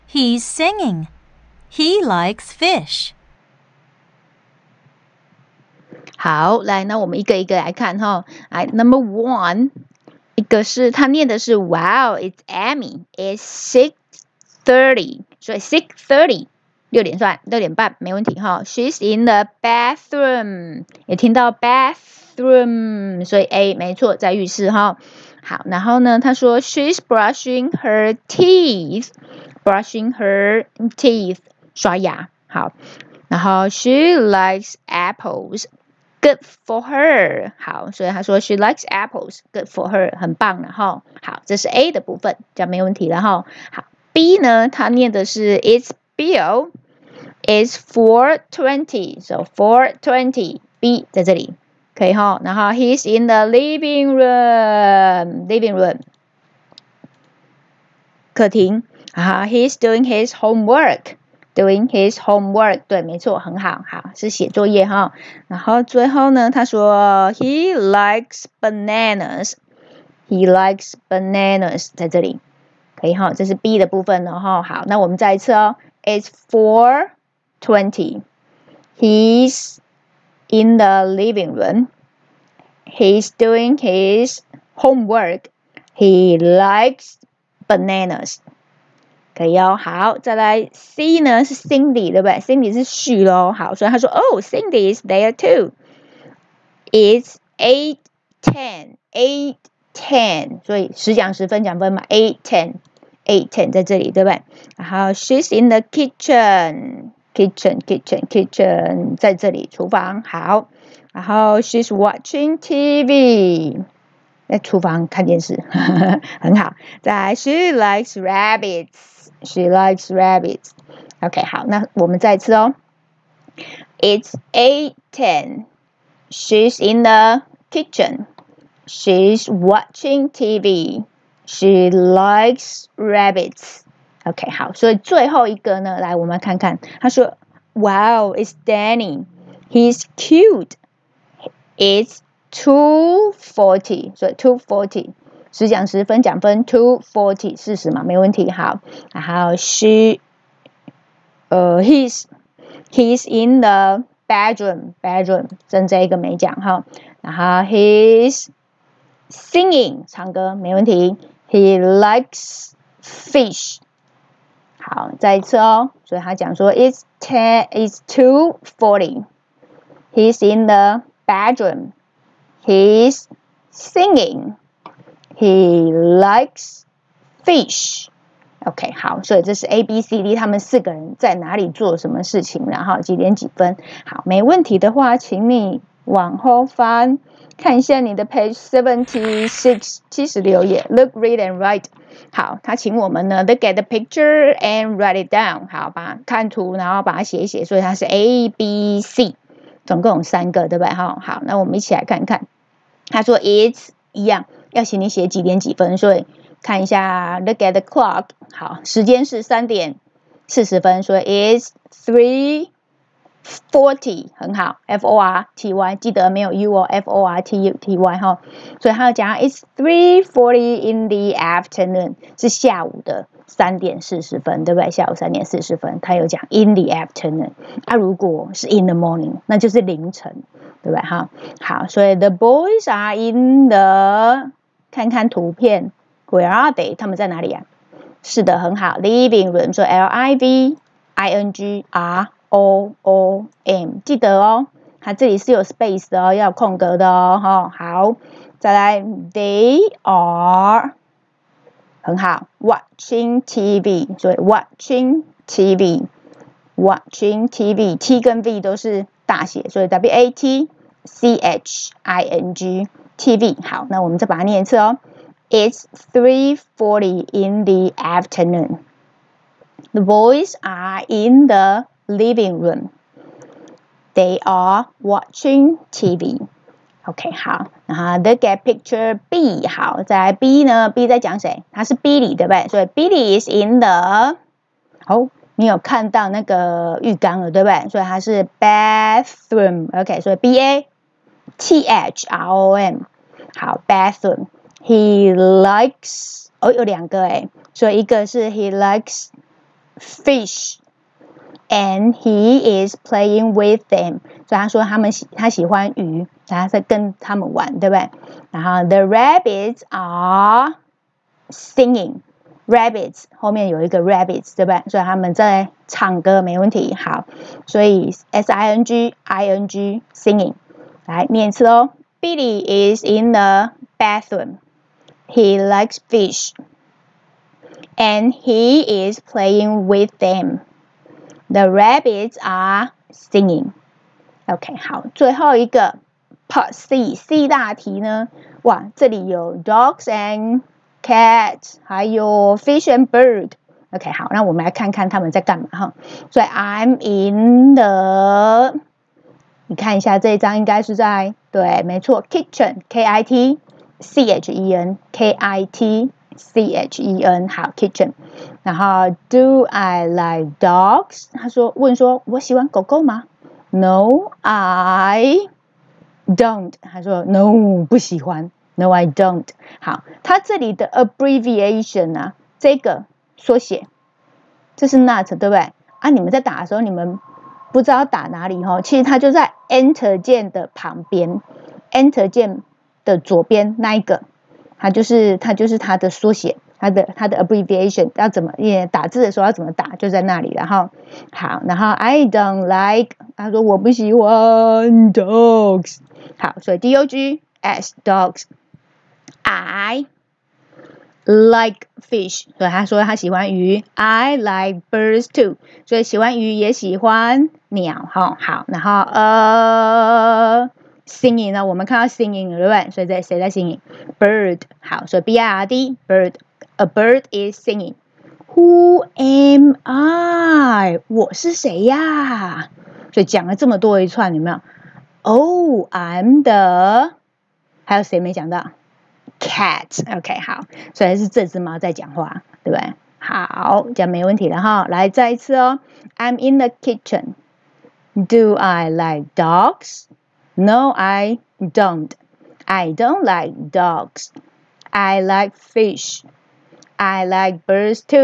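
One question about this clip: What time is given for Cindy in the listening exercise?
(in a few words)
8:10.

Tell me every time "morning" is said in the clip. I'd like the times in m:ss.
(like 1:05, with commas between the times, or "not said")
3:48.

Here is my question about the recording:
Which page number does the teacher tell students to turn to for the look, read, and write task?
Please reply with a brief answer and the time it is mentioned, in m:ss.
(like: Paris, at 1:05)
76, at 3:08.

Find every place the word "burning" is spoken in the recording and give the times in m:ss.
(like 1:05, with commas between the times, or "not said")
not said.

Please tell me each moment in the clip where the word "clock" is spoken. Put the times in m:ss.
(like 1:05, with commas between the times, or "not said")
3:27.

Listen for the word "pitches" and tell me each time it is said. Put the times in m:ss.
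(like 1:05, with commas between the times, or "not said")
not said.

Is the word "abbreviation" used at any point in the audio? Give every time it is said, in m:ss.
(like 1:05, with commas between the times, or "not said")
6:10, 6:27.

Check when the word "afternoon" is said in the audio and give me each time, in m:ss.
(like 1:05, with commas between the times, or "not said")
3:41, 3:46, 4:27.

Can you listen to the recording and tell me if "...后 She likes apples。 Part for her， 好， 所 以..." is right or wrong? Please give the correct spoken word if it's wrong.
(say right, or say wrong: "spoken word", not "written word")
wrong: "Good", not "Part".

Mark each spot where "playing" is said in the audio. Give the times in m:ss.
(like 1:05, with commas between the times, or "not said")
5:02, 5:29.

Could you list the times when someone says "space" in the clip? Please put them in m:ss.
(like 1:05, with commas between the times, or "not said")
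4:05.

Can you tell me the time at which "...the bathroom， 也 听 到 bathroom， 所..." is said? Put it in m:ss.
0:19.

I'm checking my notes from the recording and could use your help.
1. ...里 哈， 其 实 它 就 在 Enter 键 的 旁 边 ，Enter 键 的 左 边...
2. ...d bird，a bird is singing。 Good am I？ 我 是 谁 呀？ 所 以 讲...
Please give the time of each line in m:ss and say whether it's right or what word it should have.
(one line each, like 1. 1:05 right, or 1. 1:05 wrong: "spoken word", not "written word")
1. 6:18 right
2. 6:55 wrong: "Who", not "Good".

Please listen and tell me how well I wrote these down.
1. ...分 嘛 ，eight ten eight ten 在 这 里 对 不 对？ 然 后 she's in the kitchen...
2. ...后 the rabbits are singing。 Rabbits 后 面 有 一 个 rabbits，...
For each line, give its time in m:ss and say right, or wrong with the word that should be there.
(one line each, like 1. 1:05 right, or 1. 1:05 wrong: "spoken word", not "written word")
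1. 1:41 right
2. 5:08 right.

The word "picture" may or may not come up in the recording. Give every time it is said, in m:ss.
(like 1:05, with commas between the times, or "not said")
3:13, 4:38.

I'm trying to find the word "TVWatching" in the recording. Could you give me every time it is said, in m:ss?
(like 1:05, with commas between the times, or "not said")
4:15.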